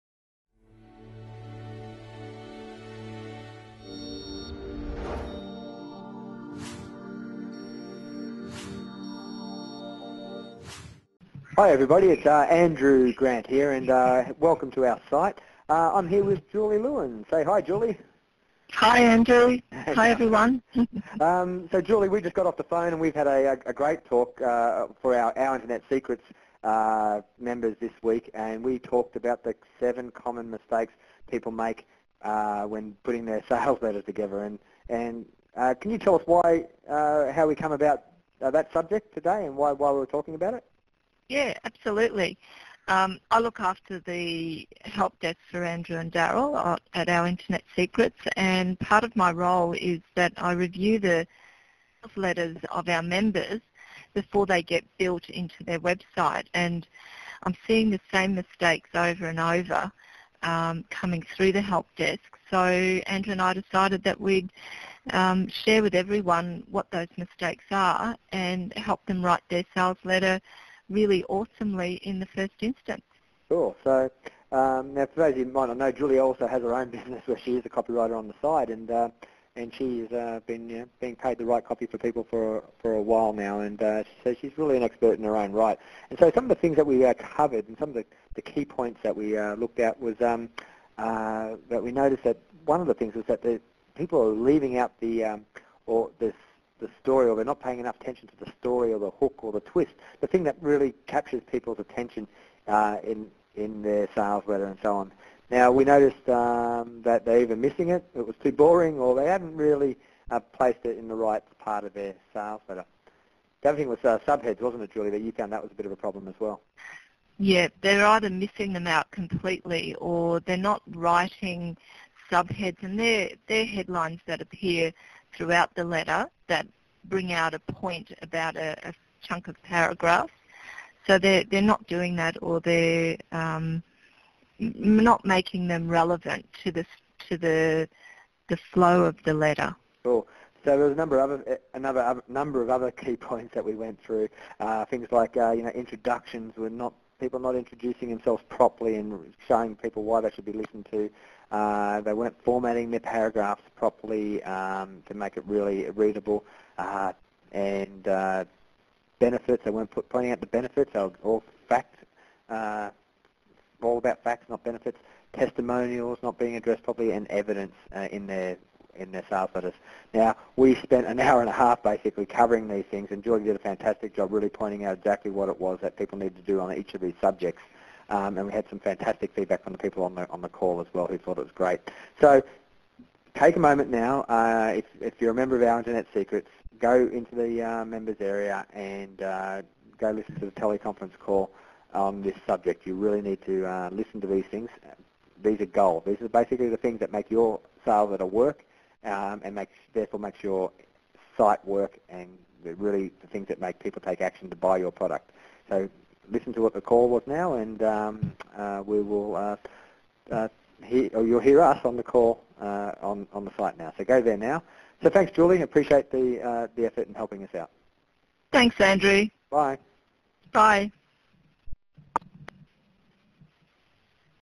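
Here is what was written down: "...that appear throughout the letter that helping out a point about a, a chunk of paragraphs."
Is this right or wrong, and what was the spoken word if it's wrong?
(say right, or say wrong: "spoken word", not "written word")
wrong: "bring", not "helping".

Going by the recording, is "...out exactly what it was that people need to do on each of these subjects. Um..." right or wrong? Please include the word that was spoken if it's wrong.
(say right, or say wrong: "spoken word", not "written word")
right.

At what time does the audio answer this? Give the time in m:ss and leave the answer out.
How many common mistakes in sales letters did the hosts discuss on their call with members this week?
0:29.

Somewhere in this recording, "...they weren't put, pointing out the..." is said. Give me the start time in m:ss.
2:39.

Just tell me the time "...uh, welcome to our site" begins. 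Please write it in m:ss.
0:13.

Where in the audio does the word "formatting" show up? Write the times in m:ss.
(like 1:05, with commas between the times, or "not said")
2:32.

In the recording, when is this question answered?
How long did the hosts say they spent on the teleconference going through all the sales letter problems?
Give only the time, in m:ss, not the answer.
2:51.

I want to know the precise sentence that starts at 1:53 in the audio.
The other thing was uh, subheads, wasn't it, Julie, that you found that was a bit of a problem as well?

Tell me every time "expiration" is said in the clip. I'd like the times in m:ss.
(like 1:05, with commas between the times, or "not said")
not said.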